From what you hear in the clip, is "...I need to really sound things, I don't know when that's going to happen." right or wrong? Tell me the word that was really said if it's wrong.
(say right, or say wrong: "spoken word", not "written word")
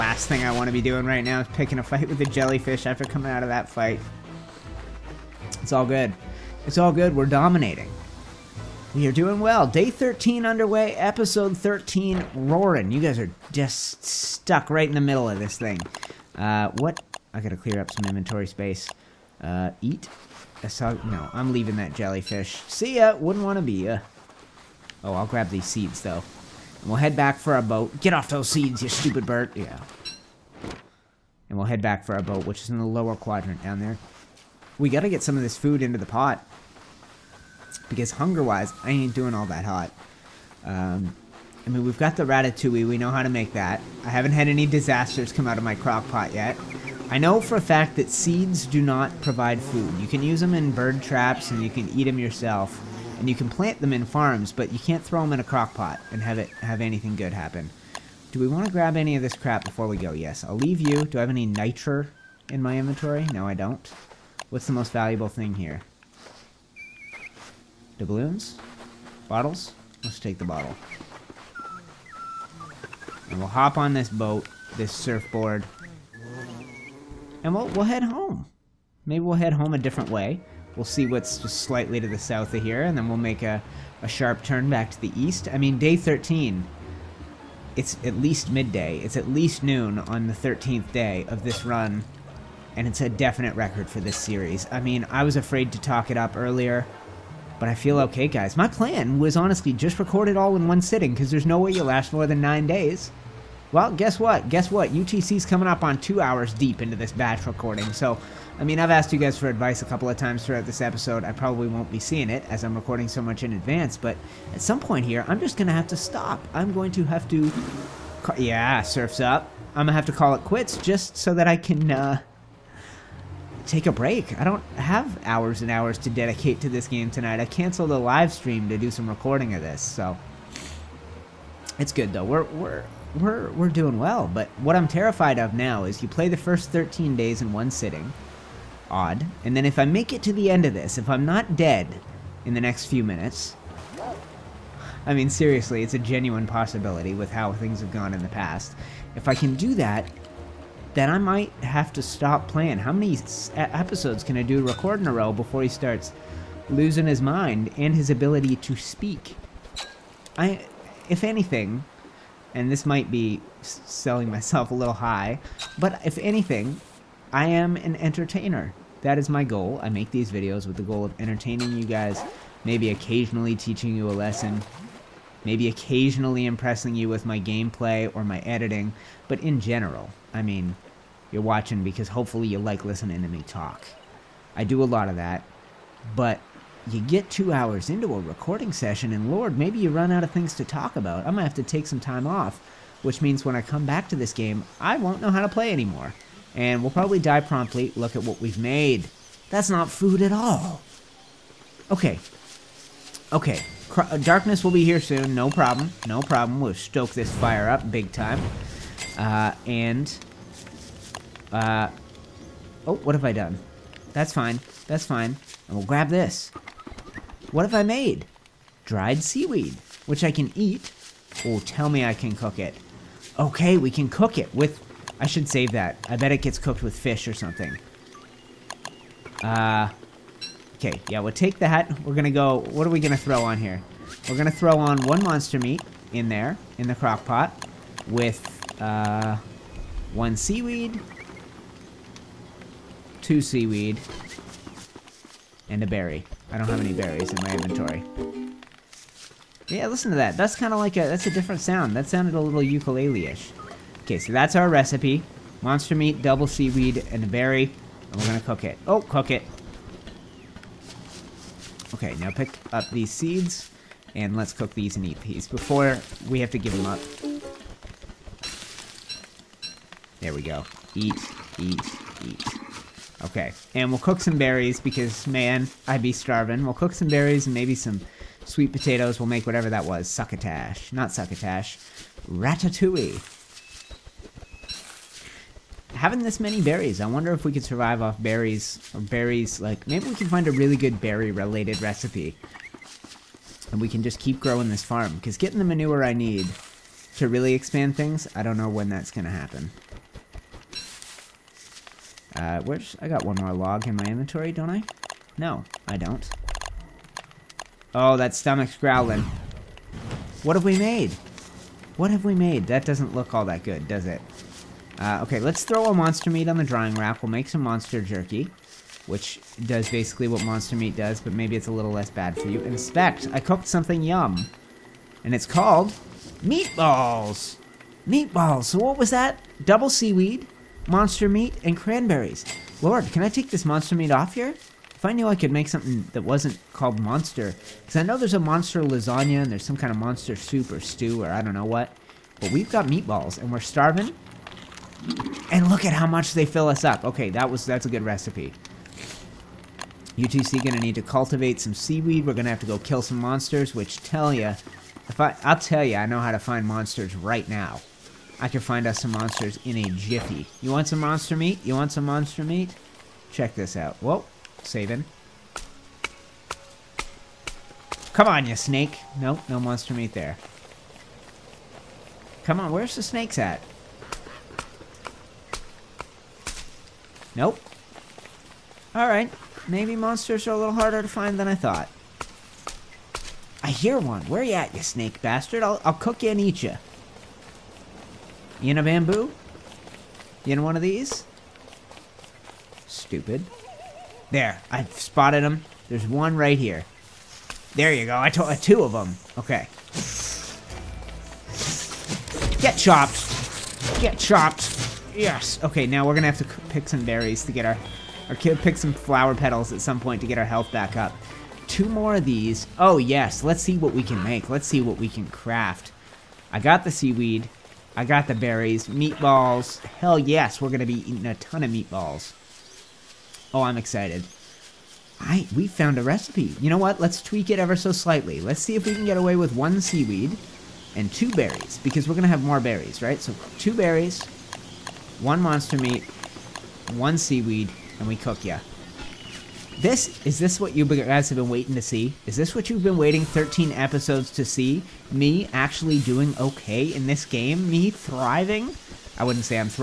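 wrong: "expand", not "sound".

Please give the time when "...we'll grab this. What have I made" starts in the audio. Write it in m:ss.
3:35.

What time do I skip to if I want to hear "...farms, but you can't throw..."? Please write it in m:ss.
0:54.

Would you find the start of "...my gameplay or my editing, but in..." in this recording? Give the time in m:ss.
2:57.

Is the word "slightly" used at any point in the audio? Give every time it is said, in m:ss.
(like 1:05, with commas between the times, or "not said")
1:21, 7:07.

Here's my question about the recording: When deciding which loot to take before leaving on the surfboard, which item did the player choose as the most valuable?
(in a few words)
The bottle.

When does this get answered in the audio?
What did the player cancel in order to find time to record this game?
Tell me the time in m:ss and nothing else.
2:07.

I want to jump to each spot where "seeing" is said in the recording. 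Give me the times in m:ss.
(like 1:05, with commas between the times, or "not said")
1:51.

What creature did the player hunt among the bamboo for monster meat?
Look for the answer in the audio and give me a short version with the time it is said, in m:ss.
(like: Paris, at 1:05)
Snakes, at 6:13.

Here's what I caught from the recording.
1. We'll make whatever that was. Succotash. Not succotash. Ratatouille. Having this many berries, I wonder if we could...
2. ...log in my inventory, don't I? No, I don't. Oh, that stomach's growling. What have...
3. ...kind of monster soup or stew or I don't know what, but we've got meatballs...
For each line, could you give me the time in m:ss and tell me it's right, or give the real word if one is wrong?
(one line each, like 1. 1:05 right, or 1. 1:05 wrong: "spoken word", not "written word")
1. 4:39 right
2. 5:03 right
3. 5:39 right.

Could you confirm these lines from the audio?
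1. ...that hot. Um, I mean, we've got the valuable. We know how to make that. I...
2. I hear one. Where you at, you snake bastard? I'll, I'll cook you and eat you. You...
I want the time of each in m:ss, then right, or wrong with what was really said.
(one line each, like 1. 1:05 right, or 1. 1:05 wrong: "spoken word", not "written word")
1. 0:39 wrong: "ratatouille", not "valuable"
2. 6:23 right.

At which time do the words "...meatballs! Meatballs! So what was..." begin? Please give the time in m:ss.
5:26.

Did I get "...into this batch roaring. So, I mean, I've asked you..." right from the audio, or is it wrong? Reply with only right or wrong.
wrong.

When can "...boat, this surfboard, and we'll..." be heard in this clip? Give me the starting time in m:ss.
1:14.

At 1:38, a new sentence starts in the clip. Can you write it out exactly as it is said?
My plan was honestly just record it all in one sitting, because there's no way you'll last more than nine days.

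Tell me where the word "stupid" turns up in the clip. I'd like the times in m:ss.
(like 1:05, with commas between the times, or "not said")
0:28, 6:32.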